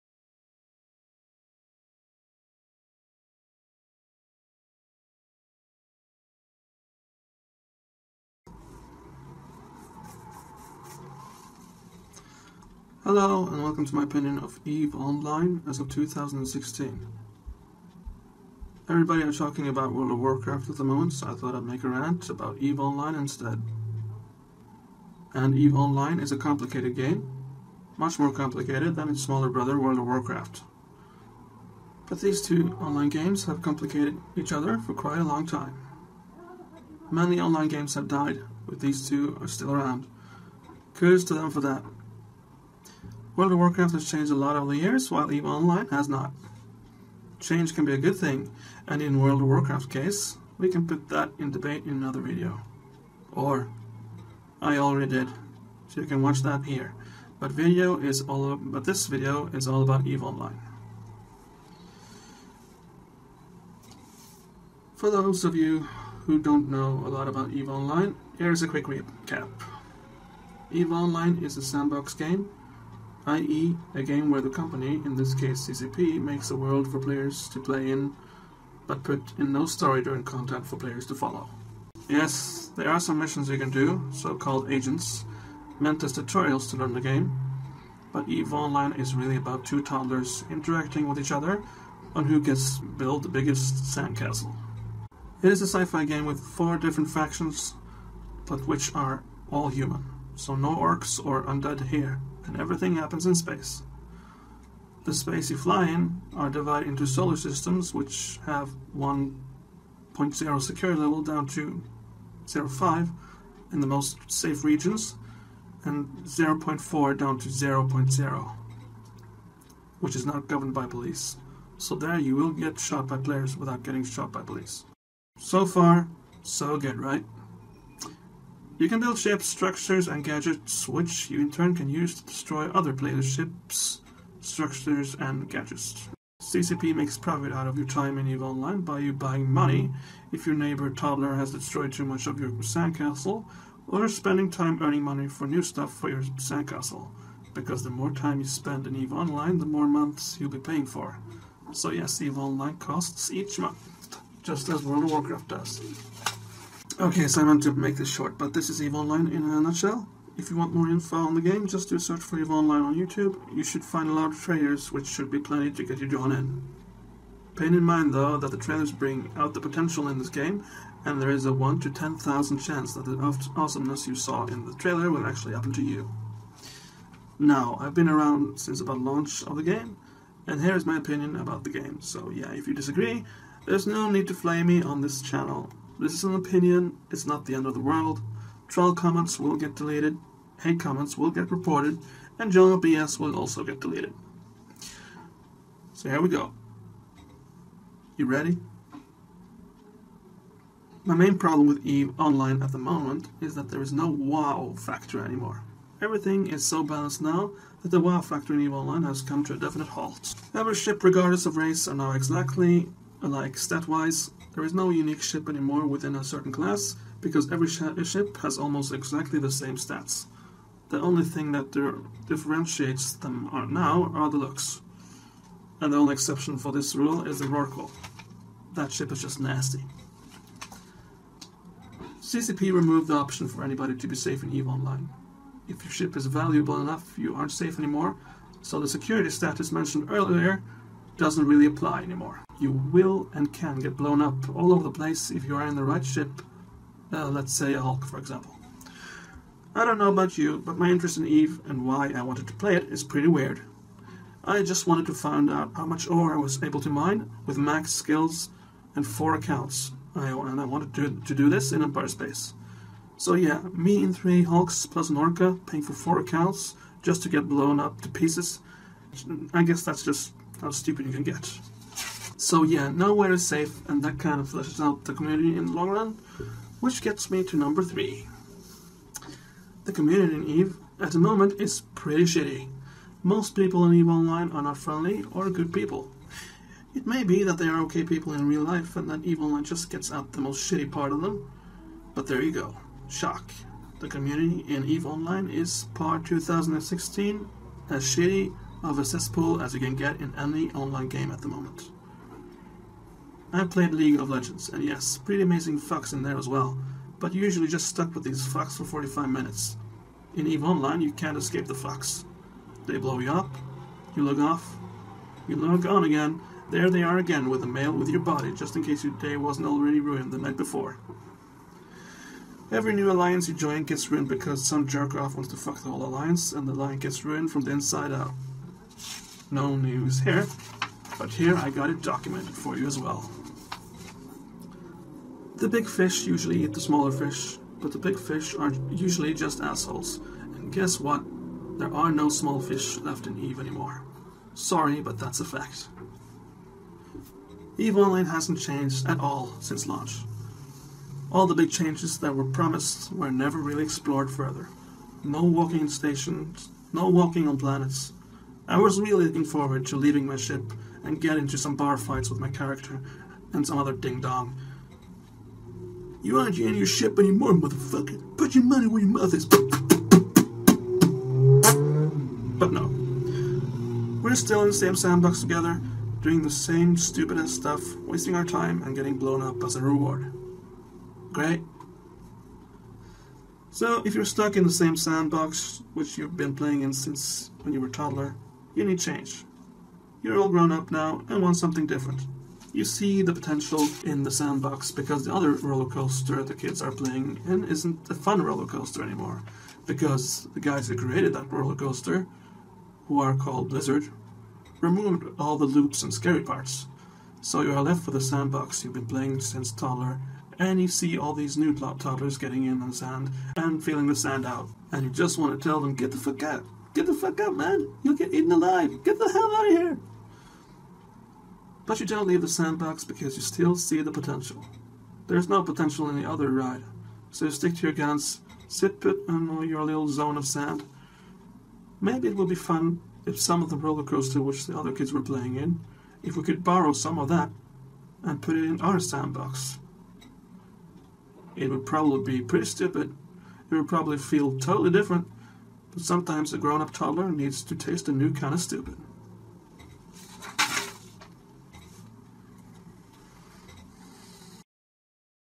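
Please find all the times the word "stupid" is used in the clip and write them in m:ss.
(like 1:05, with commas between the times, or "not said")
4:30, 6:16, 7:22, 7:28.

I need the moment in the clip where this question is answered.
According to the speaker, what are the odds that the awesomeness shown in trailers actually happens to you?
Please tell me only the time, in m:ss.
2:51.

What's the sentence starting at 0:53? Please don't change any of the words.
Or, I already did, so you can watch that here.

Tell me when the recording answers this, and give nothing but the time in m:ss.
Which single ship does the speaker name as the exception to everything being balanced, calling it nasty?
3:47.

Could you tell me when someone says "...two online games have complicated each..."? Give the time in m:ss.
0:32.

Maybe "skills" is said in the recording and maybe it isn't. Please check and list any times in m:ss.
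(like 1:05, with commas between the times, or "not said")
4:17.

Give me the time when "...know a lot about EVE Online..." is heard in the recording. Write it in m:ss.
1:06.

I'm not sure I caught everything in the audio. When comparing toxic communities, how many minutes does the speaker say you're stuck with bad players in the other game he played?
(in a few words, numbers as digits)
45.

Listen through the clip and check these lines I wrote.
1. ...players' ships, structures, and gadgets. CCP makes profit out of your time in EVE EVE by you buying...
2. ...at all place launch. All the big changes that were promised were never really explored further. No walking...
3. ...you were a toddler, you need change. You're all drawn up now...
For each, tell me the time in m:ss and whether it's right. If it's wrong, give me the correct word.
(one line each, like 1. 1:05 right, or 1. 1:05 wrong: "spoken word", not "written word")
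1. 2:12 wrong: "Online", not "EVE"
2. 5:49 wrong: "since", not "place"
3. 6:27 wrong: "grown", not "drawn".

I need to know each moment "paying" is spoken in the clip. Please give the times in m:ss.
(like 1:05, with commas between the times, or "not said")
2:30, 4:25.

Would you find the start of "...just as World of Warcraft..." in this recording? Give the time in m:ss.
2:34.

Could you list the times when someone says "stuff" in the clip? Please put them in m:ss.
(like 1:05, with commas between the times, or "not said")
2:25, 6:17.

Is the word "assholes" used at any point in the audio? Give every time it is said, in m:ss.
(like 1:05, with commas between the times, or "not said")
5:39.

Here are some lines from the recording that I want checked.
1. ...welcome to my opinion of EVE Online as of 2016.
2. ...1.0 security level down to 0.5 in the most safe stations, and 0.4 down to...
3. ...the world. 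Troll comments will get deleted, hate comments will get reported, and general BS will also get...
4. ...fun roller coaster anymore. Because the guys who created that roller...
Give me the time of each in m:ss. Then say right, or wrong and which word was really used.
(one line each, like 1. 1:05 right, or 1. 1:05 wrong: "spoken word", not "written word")
1. 0:13 right
2. 1:48 wrong: "regions", not "stations"
3. 3:07 right
4. 6:38 right.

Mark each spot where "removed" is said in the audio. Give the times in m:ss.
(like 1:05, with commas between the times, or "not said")
3:52, 6:44.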